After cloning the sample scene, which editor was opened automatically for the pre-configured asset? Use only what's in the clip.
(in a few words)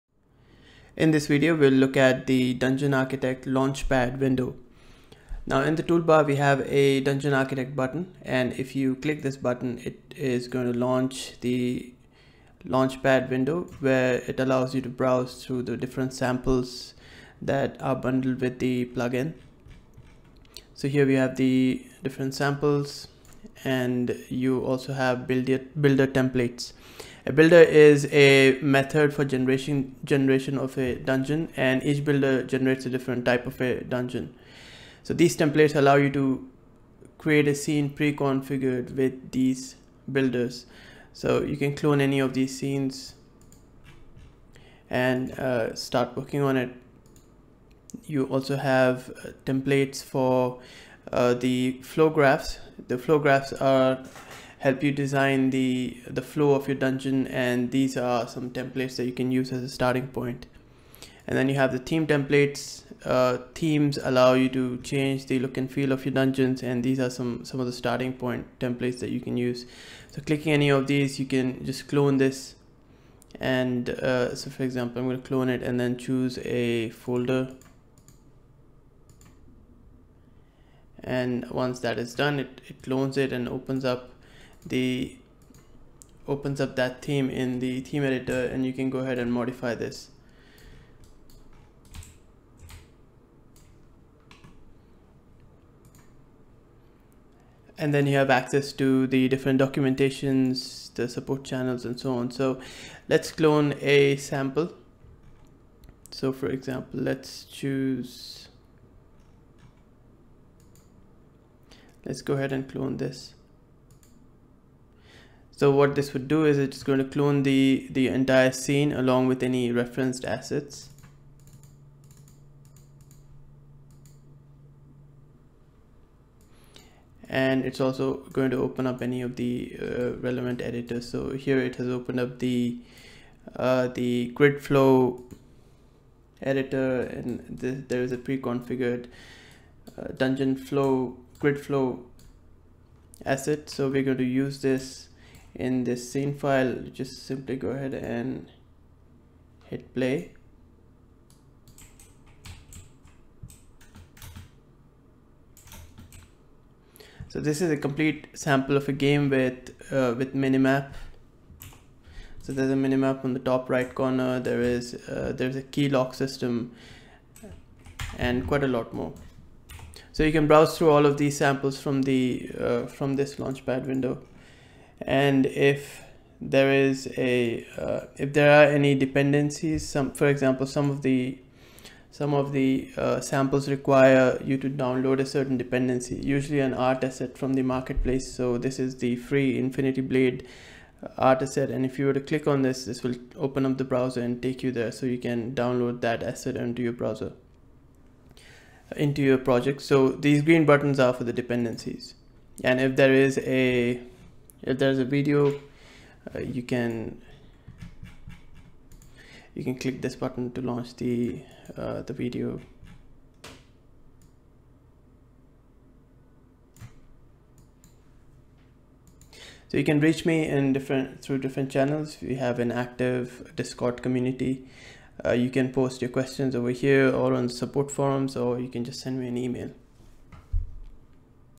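Grid flow editor.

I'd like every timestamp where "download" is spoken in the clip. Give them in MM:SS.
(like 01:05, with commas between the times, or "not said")
03:04, 03:15.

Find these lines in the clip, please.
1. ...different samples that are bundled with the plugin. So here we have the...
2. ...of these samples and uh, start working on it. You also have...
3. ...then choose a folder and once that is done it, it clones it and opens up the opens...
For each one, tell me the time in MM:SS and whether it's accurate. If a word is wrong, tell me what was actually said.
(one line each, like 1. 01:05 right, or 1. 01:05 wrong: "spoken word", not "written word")
1. 00:15 right
2. 00:42 wrong: "scenes", not "samples"
3. 01:15 right.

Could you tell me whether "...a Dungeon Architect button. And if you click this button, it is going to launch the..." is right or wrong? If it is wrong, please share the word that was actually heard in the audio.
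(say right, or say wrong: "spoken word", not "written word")
right.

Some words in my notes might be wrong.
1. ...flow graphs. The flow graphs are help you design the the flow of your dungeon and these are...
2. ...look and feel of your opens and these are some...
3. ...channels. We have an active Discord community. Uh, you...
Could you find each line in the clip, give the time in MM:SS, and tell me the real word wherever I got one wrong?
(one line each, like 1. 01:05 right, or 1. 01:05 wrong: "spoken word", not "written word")
1. 00:51 right
2. 01:05 wrong: "dungeons", not "opens"
3. 03:41 right.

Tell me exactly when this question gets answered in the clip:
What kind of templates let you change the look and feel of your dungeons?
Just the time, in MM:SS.
01:01.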